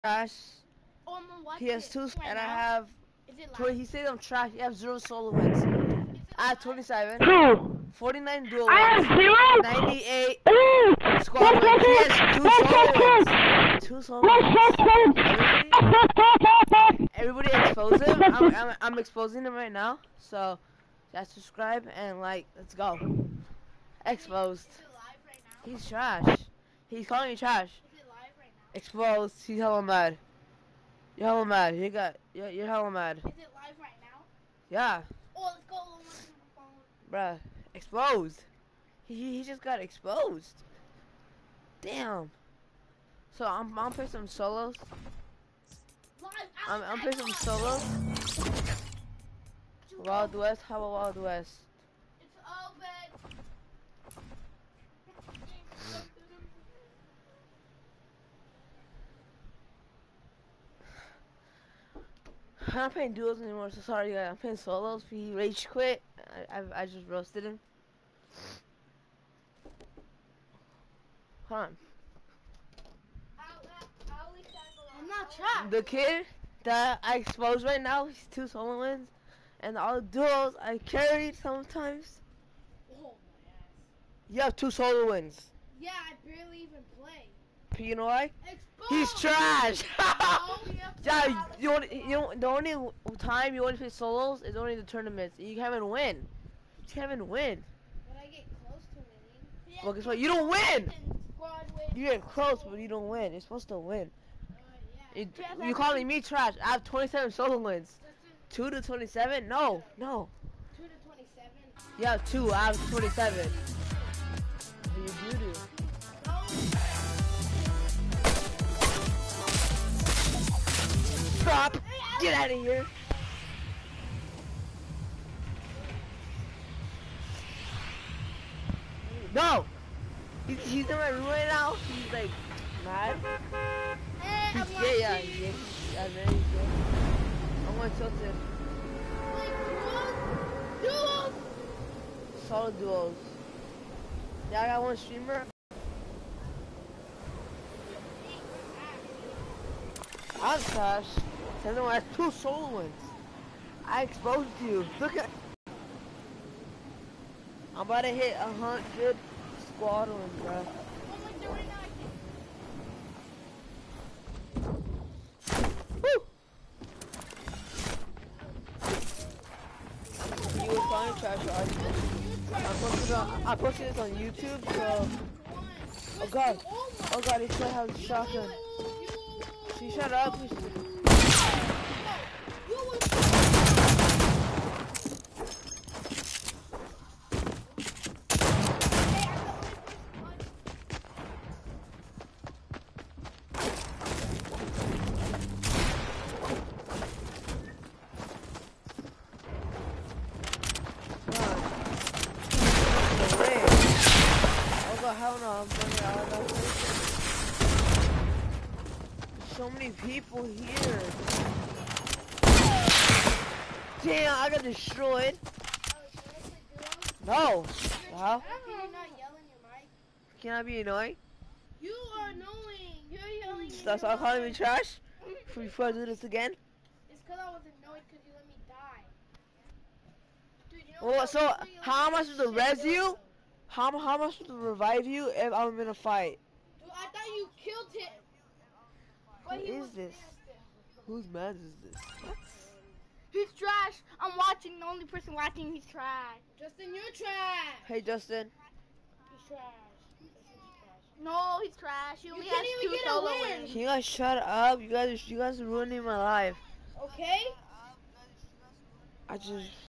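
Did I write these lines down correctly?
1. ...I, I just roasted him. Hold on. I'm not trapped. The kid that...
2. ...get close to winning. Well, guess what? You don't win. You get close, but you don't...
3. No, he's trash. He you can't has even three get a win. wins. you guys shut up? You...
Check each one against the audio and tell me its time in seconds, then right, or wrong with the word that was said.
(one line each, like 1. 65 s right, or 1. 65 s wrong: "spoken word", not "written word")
1. 66 s right
2. 98 s right
3. 251 s wrong: "two", not "three".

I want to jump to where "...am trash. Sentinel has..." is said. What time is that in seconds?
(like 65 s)
150 s.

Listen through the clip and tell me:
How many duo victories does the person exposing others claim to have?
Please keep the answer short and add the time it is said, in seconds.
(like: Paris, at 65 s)
49, at 7 s.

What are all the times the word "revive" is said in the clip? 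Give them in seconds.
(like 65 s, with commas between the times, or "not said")
234 s.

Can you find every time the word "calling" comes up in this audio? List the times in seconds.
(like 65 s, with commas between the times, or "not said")
27 s, 105 s, 170 s, 224 s.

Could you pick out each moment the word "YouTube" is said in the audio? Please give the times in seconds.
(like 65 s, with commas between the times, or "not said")
174 s.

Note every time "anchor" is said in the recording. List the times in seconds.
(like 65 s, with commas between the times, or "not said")
not said.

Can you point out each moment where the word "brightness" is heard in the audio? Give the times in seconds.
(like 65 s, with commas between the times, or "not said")
not said.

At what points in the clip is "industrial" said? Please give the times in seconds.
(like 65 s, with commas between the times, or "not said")
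not said.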